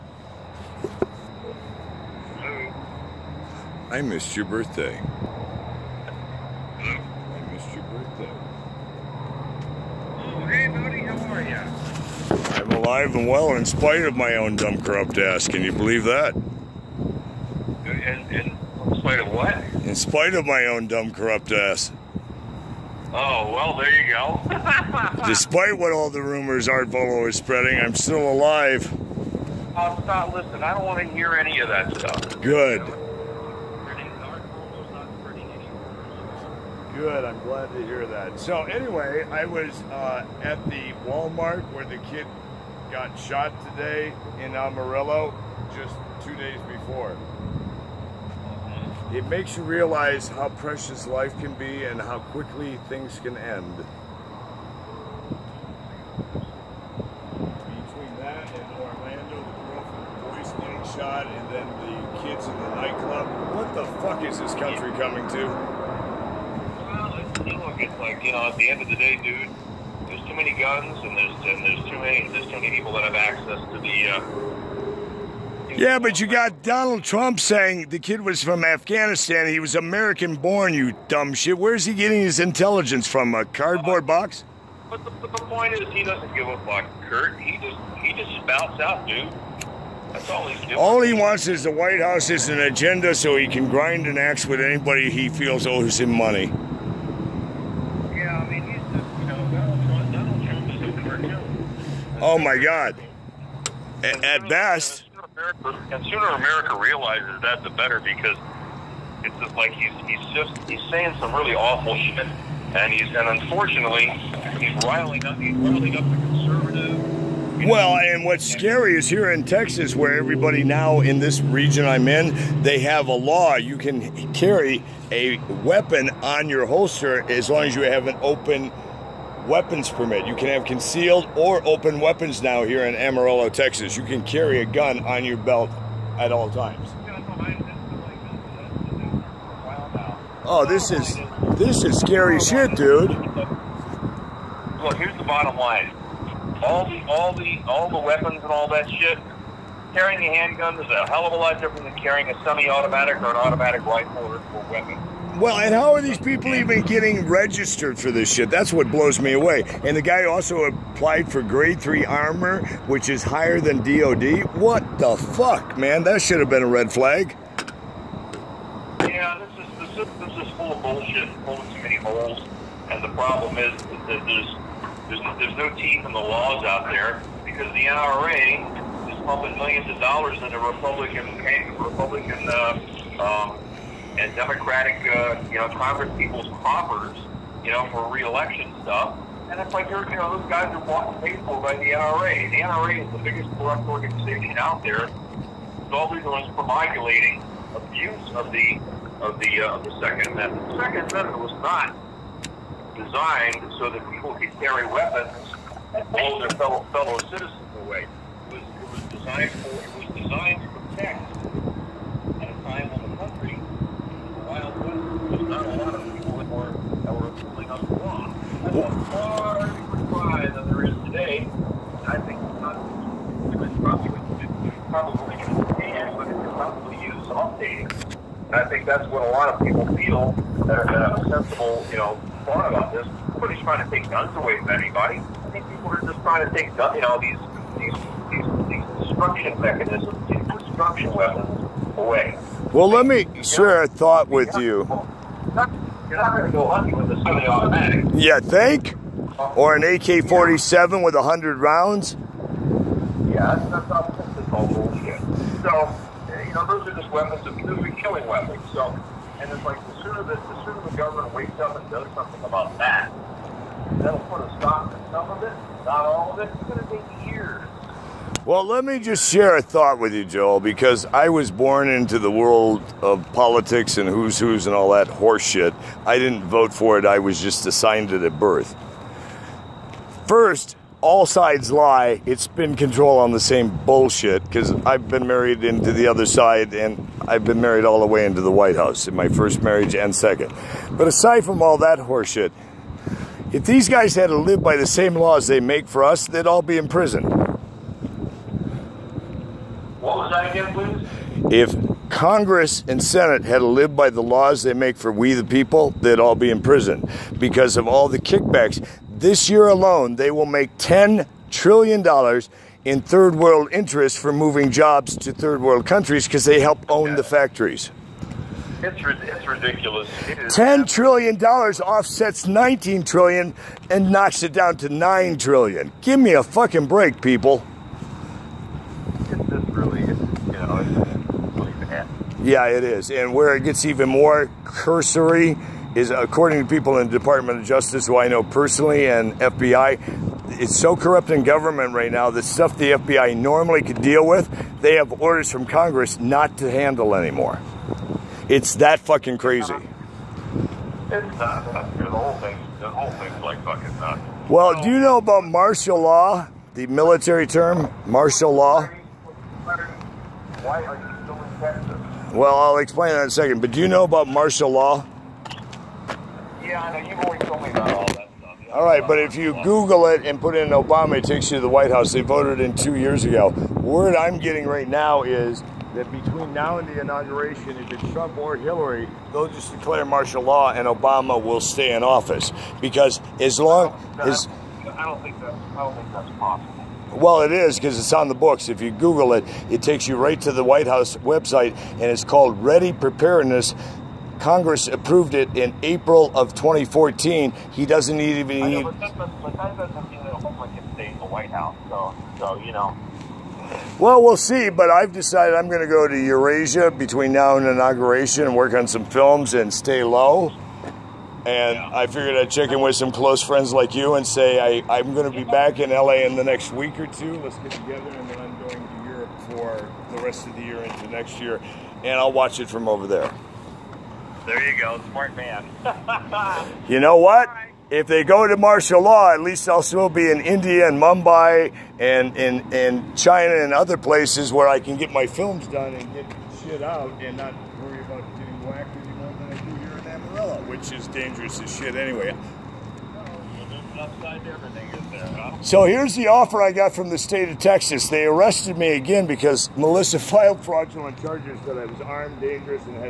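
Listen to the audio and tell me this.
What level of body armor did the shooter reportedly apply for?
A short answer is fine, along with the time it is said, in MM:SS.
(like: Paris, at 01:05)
grade three, at 02:41.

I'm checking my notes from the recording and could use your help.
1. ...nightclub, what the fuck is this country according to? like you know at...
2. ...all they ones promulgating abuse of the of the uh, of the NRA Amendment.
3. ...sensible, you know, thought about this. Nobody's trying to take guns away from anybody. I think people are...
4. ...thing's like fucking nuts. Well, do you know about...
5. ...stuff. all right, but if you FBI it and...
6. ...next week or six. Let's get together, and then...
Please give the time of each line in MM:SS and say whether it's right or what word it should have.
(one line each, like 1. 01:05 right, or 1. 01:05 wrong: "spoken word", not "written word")
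1. 01:02 wrong: "coming", not "according"
2. 03:15 wrong: "Second", not "NRA"
3. 03:51 right
4. 05:53 right
5. 06:08 wrong: "Google", not "FBI"
6. 06:56 wrong: "two", not "six".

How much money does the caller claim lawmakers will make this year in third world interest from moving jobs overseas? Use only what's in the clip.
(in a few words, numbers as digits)
$10 trillion.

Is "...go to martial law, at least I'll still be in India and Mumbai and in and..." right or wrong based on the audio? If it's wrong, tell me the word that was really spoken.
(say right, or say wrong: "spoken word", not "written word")
right.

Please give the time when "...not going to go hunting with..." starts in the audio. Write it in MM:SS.
04:06.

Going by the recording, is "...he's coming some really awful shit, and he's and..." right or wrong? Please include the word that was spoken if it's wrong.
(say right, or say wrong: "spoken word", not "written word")
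wrong: "saying", not "coming".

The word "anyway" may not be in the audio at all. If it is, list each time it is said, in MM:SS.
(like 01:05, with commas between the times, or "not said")
00:38, 07:21.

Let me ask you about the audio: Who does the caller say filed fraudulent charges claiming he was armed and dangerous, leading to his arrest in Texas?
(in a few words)
Melissa.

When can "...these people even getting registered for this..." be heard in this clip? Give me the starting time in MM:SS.
02:36.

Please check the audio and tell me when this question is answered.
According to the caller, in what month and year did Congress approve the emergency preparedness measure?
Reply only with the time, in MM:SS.
06:35.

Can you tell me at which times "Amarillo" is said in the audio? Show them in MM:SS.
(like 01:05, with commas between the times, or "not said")
00:44, 02:12.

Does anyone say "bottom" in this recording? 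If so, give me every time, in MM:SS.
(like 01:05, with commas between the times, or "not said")
02:25.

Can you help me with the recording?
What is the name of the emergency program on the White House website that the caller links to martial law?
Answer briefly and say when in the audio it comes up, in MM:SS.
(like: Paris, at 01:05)
Ready Preparedness, at 06:32.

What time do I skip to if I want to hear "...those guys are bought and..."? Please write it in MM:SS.
03:10.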